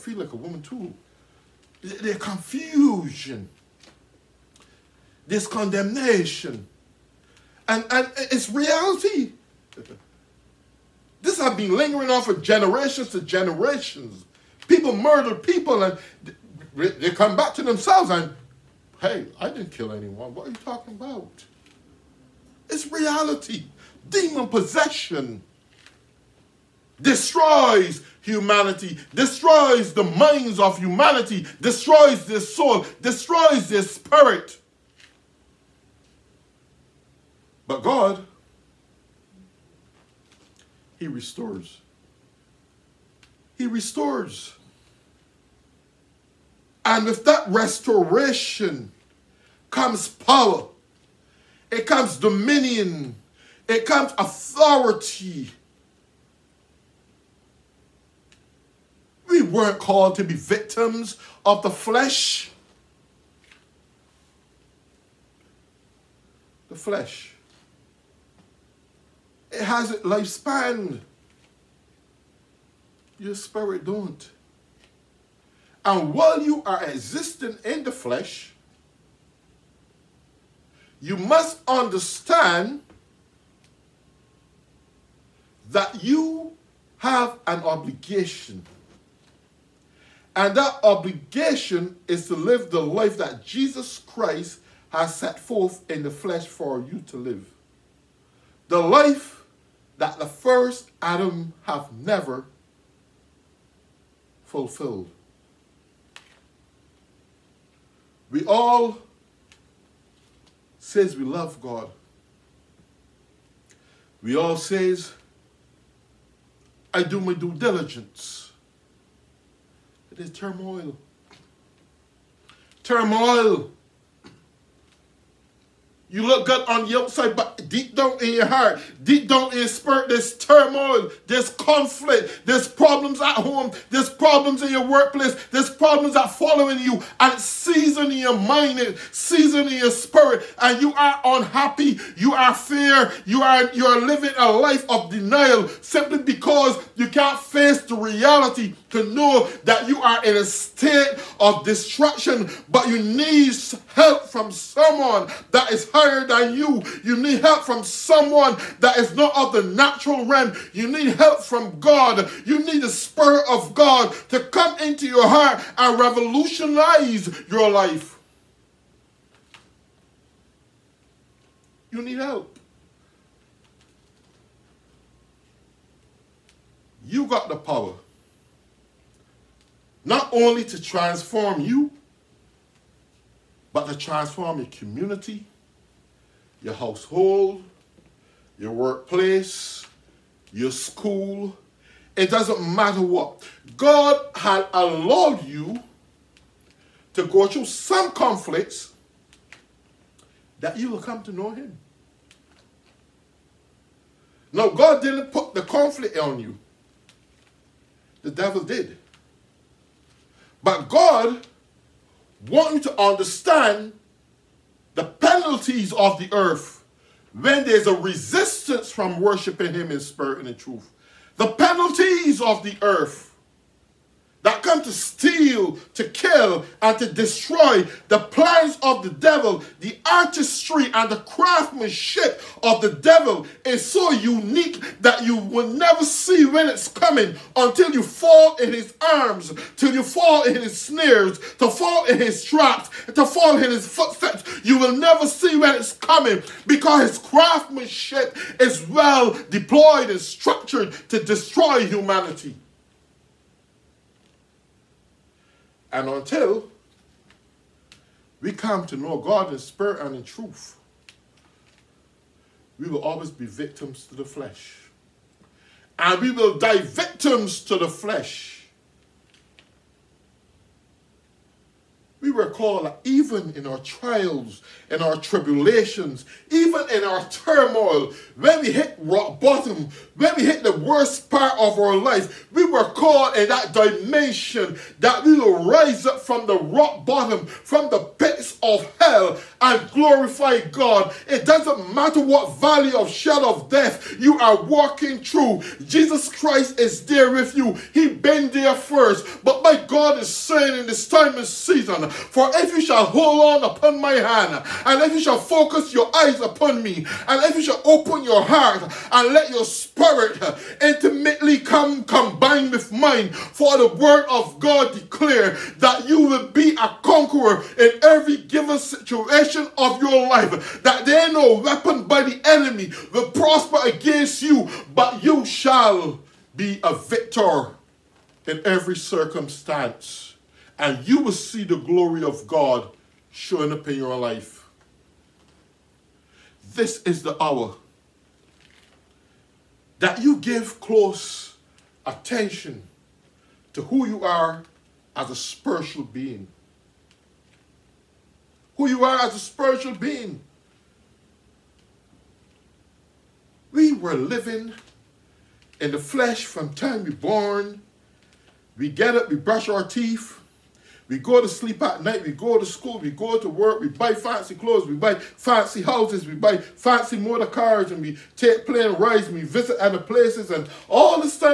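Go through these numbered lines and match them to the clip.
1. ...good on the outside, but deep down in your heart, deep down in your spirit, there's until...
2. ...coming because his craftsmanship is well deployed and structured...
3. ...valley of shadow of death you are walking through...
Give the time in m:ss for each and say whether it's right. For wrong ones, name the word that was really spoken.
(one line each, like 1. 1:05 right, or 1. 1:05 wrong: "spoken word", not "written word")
1. 2:06 wrong: "turmoil", not "until"
2. 4:05 right
3. 4:52 right.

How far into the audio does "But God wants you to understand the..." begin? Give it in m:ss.
3:30.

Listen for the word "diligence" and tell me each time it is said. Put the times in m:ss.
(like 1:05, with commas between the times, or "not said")
1:57.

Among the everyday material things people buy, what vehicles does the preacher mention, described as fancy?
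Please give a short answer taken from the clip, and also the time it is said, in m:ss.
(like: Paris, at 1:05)
Motor cars, at 6:07.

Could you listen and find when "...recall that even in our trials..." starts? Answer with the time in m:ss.
4:32.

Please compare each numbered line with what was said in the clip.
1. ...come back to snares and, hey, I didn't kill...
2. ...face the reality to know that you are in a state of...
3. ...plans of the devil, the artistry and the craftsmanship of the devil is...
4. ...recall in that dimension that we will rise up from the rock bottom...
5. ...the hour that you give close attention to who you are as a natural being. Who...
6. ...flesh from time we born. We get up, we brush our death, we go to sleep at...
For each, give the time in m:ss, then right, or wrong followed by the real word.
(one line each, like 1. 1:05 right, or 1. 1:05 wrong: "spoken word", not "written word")
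1. 0:17 wrong: "themselves", not "snares"
2. 2:27 right
3. 3:48 right
4. 4:42 right
5. 5:37 wrong: "spiritual", not "natural"
6. 5:55 wrong: "teeth", not "death".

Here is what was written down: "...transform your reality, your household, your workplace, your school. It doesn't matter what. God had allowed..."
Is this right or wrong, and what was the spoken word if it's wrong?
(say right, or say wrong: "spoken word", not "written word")
wrong: "community", not "reality".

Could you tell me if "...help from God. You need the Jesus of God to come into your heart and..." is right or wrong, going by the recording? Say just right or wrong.
wrong.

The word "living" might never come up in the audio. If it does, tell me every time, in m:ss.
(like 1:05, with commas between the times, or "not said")
2:23, 5:54.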